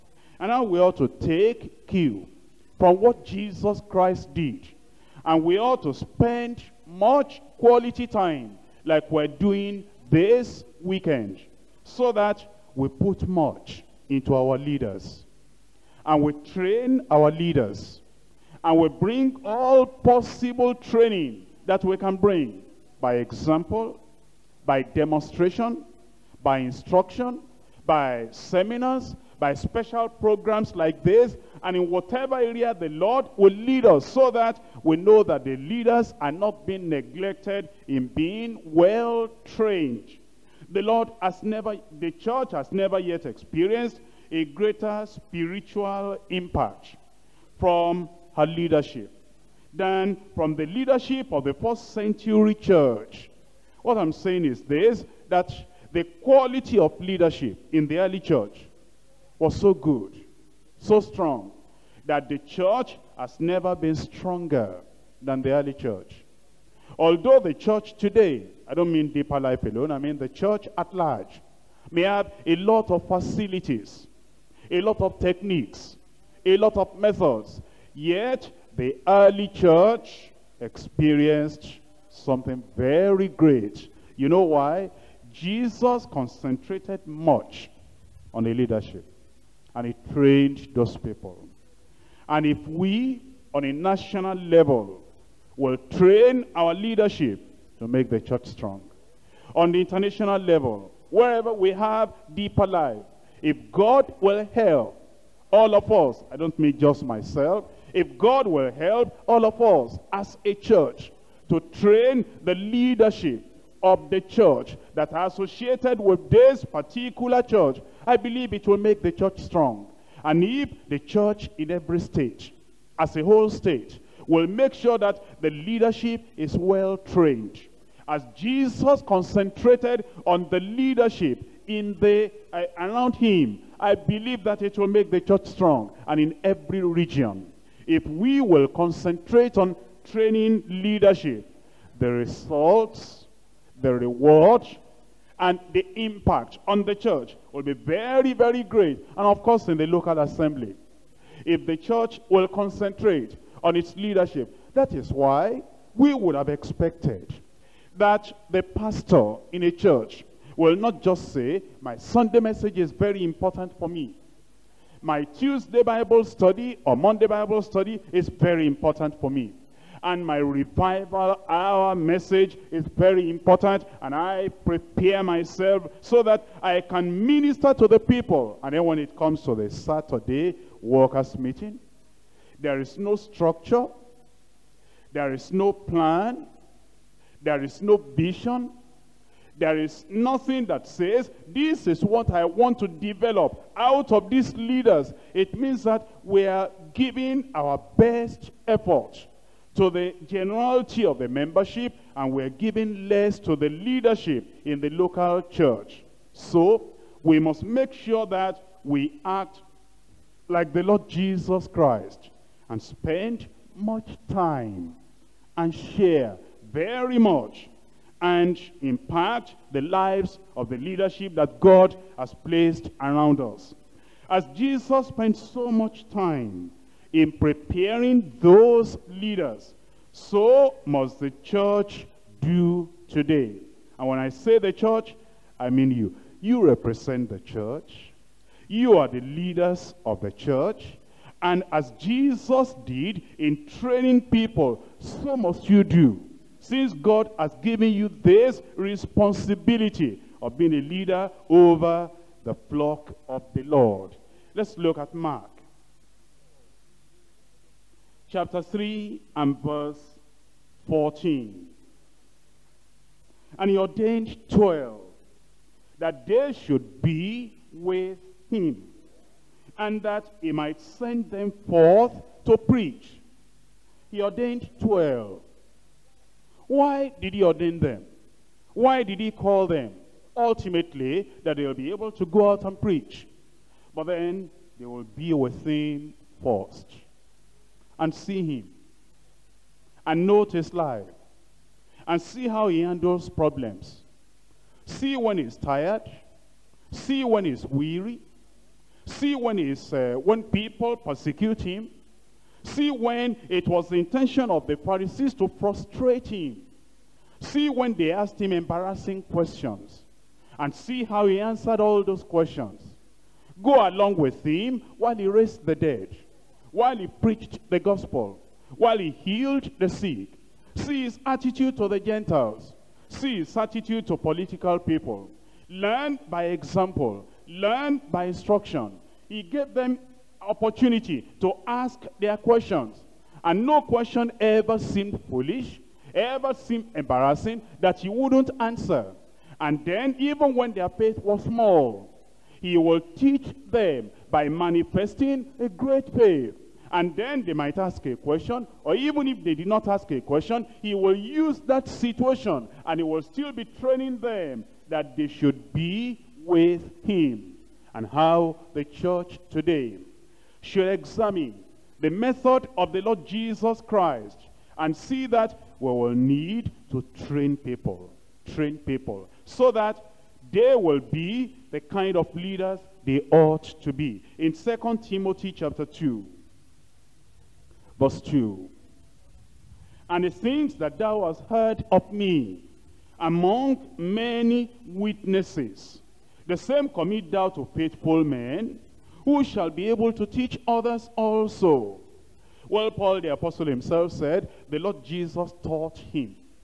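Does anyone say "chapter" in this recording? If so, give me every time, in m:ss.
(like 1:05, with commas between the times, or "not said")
4:18, 6:15.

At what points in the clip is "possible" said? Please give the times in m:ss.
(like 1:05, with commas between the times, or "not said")
0:19.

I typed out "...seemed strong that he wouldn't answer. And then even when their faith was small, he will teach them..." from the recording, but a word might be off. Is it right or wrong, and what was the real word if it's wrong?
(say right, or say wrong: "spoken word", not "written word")
wrong: "embarrassing", not "strong".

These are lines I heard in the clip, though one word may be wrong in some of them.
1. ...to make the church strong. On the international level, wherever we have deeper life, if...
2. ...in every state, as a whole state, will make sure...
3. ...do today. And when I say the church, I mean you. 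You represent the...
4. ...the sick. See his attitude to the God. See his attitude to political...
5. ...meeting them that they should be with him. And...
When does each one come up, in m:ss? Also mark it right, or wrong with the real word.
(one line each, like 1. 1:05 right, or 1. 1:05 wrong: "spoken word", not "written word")
1. 1:37 right
2. 2:01 right
3. 3:52 right
4. 5:19 wrong: "Gentiles", not "God"
5. 5:53 wrong: "training", not "meeting".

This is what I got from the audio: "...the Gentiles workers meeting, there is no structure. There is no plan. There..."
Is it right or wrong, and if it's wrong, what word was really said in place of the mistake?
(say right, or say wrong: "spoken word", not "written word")
wrong: "Saturday", not "Gentiles".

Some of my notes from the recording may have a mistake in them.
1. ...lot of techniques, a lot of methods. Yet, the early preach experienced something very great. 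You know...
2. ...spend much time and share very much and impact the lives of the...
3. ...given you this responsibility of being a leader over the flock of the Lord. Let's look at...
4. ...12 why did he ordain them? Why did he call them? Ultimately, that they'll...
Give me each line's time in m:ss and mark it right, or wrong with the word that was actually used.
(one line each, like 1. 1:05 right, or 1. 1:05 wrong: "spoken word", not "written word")
1. 1:14 wrong: "church", not "preach"
2. 3:32 right
3. 4:07 right
4. 4:34 right.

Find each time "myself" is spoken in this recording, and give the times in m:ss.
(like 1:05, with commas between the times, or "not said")
1:47, 2:55.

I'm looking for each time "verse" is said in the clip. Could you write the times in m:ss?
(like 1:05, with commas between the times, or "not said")
4:19, 6:17.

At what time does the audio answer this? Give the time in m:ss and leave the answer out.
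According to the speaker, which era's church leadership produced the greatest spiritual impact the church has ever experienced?
0:51.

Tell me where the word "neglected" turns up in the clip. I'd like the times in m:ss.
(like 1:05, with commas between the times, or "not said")
0:36.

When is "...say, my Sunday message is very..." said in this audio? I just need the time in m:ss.
2:41.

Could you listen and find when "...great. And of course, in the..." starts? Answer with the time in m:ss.
2:28.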